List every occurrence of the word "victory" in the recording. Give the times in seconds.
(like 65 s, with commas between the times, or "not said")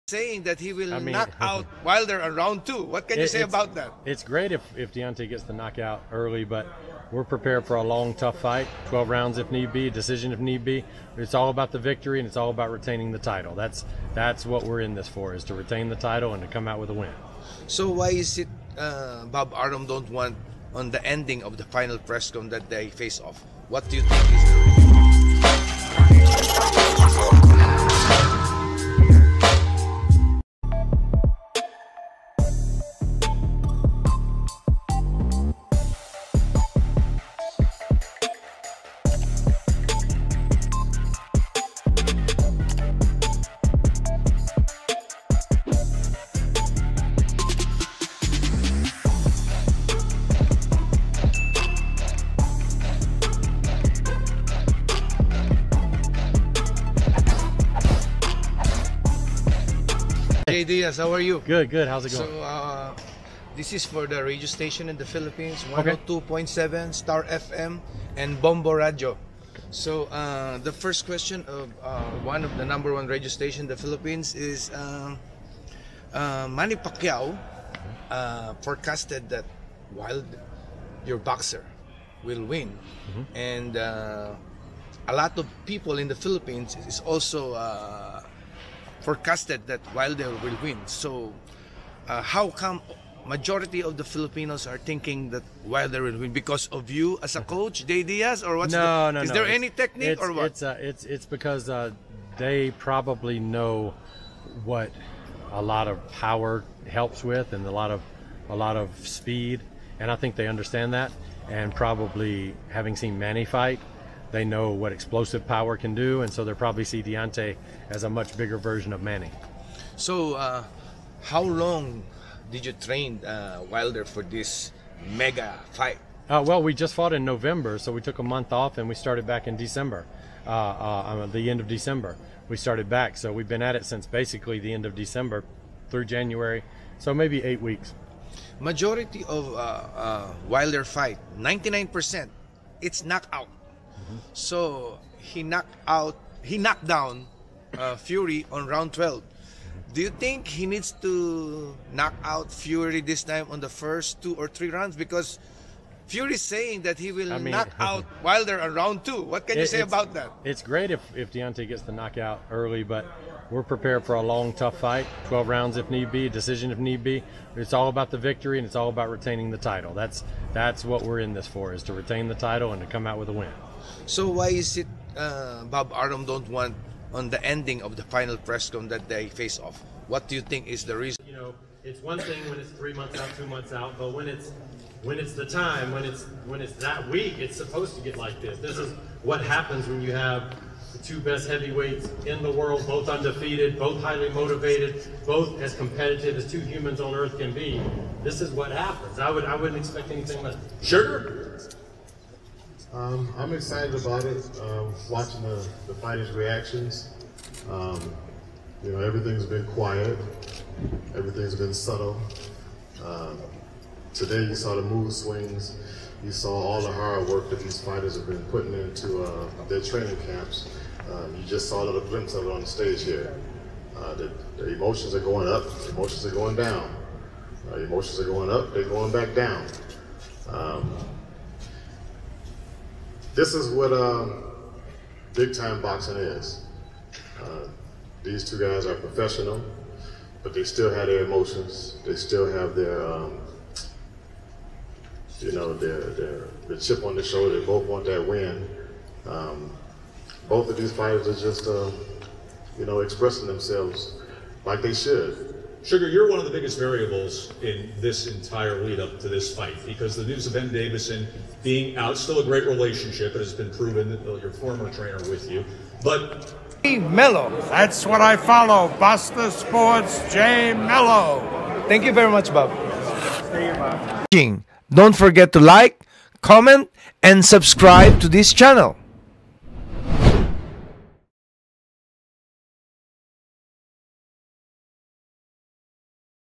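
11 s, 168 s.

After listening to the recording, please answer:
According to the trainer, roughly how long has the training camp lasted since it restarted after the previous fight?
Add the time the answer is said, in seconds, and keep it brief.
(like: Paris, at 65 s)
8 weeks, at 137 s.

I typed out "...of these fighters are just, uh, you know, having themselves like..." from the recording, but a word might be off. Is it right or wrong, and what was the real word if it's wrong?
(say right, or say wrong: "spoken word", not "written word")
wrong: "expressing", not "having".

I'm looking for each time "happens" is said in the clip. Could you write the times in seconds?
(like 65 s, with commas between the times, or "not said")
189 s, 198 s.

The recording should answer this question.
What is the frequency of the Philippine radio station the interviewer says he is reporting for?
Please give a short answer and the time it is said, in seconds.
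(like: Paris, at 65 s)
102.7, at 65 s.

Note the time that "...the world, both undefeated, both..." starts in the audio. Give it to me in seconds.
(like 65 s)
192 s.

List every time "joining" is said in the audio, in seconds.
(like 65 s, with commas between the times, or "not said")
not said.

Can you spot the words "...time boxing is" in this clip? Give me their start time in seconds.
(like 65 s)
235 s.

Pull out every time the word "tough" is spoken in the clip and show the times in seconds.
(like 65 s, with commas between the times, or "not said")
8 s, 164 s.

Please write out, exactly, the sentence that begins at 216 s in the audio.
You saw all the hard work that these fighters have been putting into uh, their training camps.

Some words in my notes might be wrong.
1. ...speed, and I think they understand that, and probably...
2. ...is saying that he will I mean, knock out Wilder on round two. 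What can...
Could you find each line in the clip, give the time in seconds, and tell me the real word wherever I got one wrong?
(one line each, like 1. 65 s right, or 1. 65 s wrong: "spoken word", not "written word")
1. 109 s right
2. 156 s right.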